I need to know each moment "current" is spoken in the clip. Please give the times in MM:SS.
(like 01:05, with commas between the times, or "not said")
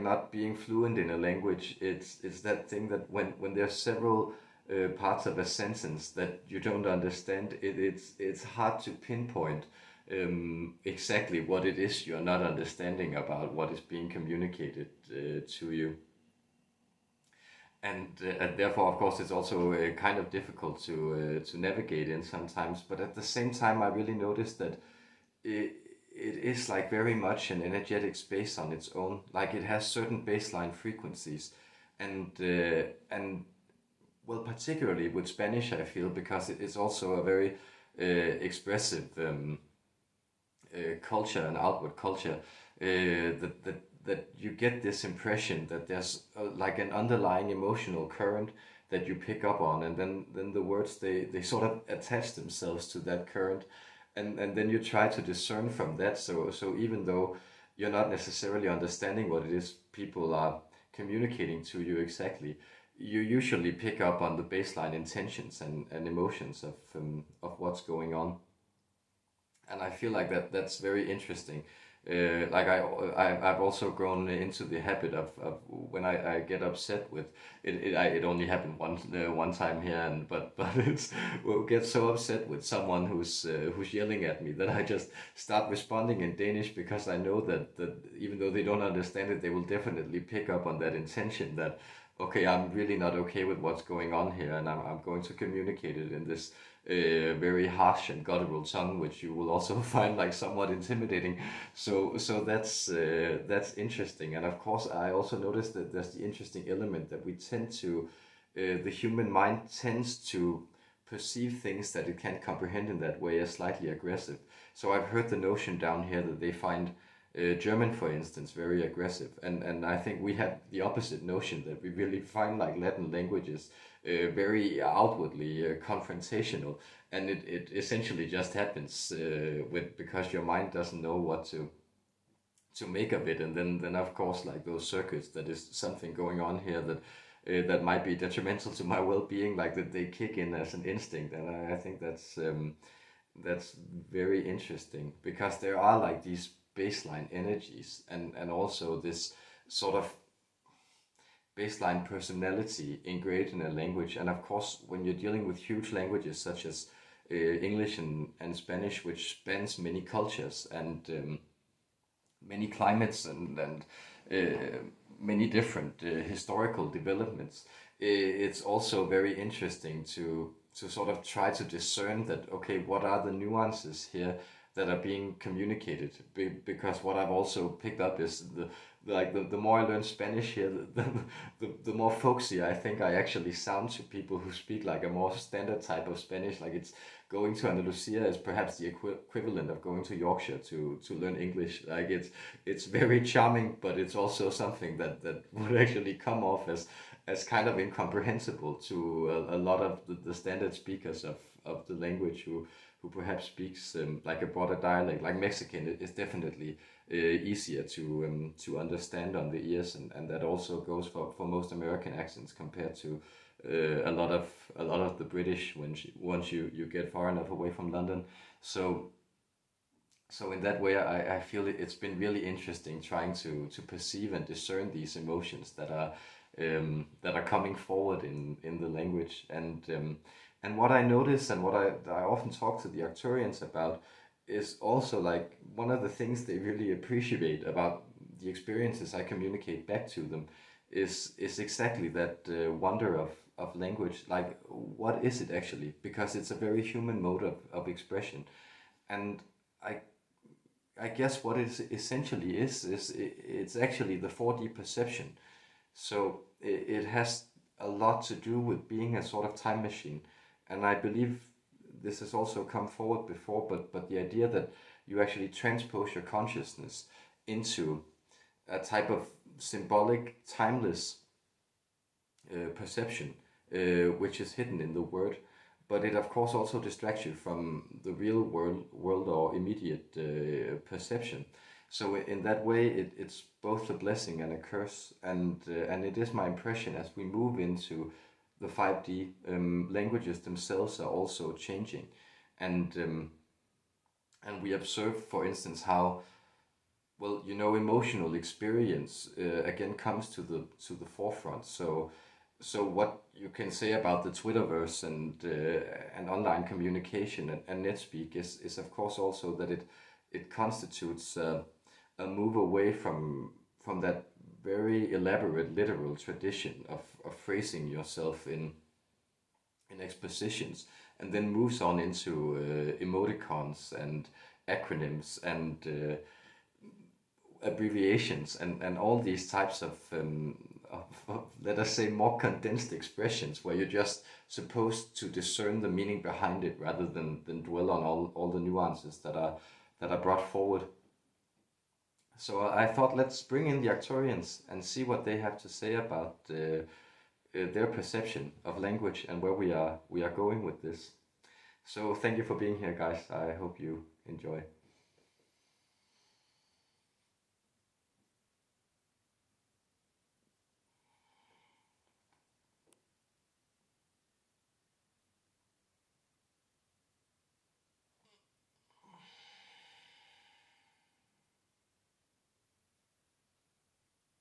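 00:48, 00:53.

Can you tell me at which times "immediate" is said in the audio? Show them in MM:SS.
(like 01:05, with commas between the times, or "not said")
04:39.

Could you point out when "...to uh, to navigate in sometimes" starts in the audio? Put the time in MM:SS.
00:20.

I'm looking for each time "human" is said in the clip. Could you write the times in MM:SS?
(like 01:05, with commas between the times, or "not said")
01:48, 04:06.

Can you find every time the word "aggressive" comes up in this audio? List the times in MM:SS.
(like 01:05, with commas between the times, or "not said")
01:53, 01:58.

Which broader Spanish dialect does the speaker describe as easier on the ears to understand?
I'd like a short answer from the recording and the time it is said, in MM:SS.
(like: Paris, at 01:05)
Mexican, at 03:25.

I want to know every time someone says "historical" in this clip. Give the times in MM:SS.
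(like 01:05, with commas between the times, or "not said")
02:46.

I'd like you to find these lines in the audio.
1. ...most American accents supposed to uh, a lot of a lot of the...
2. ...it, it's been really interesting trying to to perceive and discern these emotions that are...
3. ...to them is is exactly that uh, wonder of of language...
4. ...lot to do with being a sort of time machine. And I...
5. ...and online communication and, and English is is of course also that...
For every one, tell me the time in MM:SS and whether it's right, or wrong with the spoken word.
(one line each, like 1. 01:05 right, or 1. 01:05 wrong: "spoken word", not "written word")
1. 03:31 wrong: "compared", not "supposed"
2. 03:41 right
3. 04:00 right
4. 04:17 right
5. 05:06 wrong: "NetSpeak", not "English".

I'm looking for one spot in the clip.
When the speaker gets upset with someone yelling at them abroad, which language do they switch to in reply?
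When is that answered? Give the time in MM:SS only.
01:26.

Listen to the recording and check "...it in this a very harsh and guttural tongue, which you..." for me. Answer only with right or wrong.
right.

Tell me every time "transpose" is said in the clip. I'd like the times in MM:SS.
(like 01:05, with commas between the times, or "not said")
04:25.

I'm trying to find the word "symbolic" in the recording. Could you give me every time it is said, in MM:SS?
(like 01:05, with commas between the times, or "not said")
04:29.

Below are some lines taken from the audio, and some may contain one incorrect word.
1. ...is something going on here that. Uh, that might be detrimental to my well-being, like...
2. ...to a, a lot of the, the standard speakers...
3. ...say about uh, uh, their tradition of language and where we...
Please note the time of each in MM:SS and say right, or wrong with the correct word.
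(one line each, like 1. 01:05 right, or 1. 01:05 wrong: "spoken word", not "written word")
1. 02:15 right
2. 03:18 right
3. 05:45 wrong: "perception", not "tradition".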